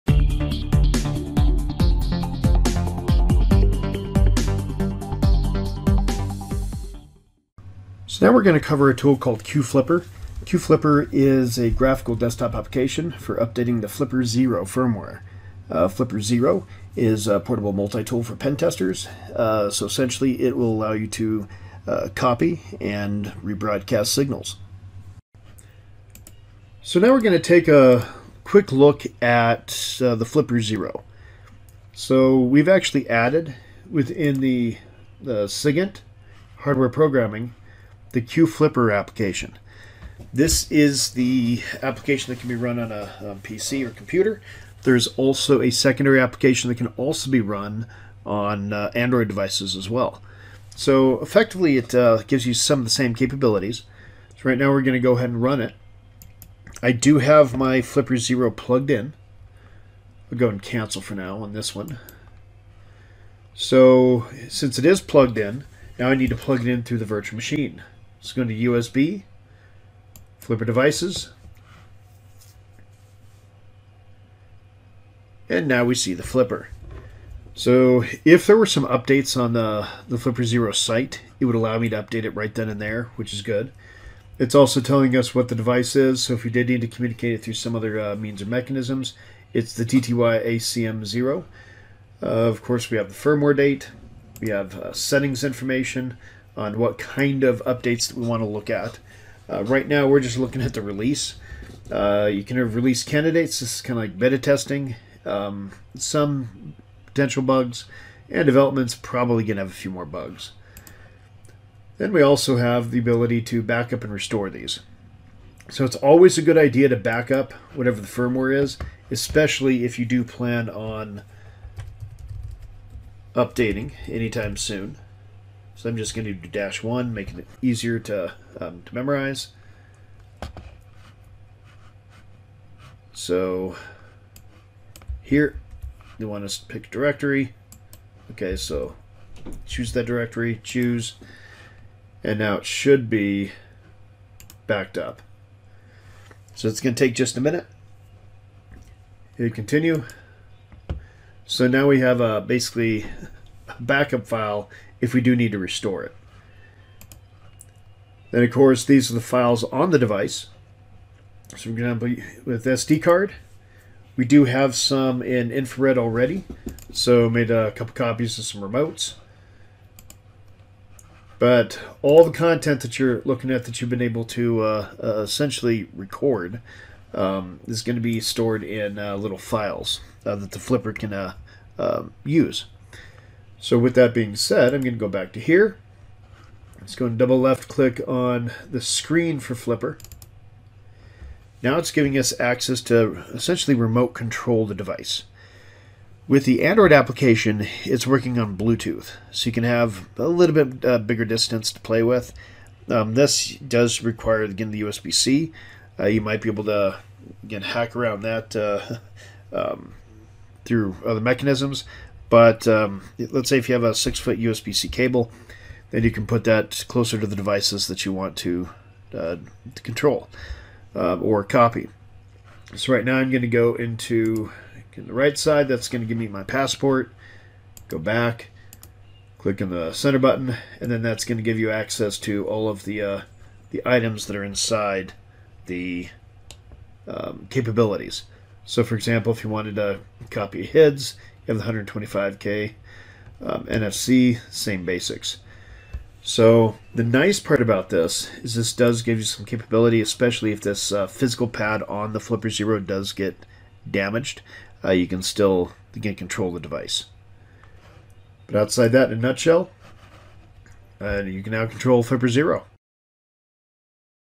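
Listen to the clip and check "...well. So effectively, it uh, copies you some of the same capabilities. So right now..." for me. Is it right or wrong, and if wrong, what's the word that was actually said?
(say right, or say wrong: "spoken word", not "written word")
wrong: "gives", not "copies".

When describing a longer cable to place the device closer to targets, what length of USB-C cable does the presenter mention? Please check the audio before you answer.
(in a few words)
6 feet.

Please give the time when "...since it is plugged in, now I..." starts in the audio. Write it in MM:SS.
01:04.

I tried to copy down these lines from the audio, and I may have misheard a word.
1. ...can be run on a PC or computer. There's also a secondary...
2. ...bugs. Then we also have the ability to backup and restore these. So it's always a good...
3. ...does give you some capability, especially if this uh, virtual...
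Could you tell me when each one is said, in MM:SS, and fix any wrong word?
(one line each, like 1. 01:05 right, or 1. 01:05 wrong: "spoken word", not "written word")
1. 00:42 right
2. 01:50 right
3. 04:08 wrong: "physical", not "virtual".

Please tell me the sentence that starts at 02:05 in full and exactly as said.
So I'm just going to do dash one, making it easier to, um, to memorize.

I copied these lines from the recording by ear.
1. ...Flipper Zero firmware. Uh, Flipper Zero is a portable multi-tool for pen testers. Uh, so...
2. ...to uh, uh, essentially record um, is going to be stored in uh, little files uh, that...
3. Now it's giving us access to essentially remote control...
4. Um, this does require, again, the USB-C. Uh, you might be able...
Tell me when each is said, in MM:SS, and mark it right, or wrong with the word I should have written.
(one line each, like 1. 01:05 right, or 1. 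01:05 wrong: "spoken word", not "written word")
1. 00:13 right
2. 02:54 right
3. 03:11 right
4. 03:22 right.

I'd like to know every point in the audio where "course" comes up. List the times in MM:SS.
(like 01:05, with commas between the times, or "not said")
01:32, 02:38.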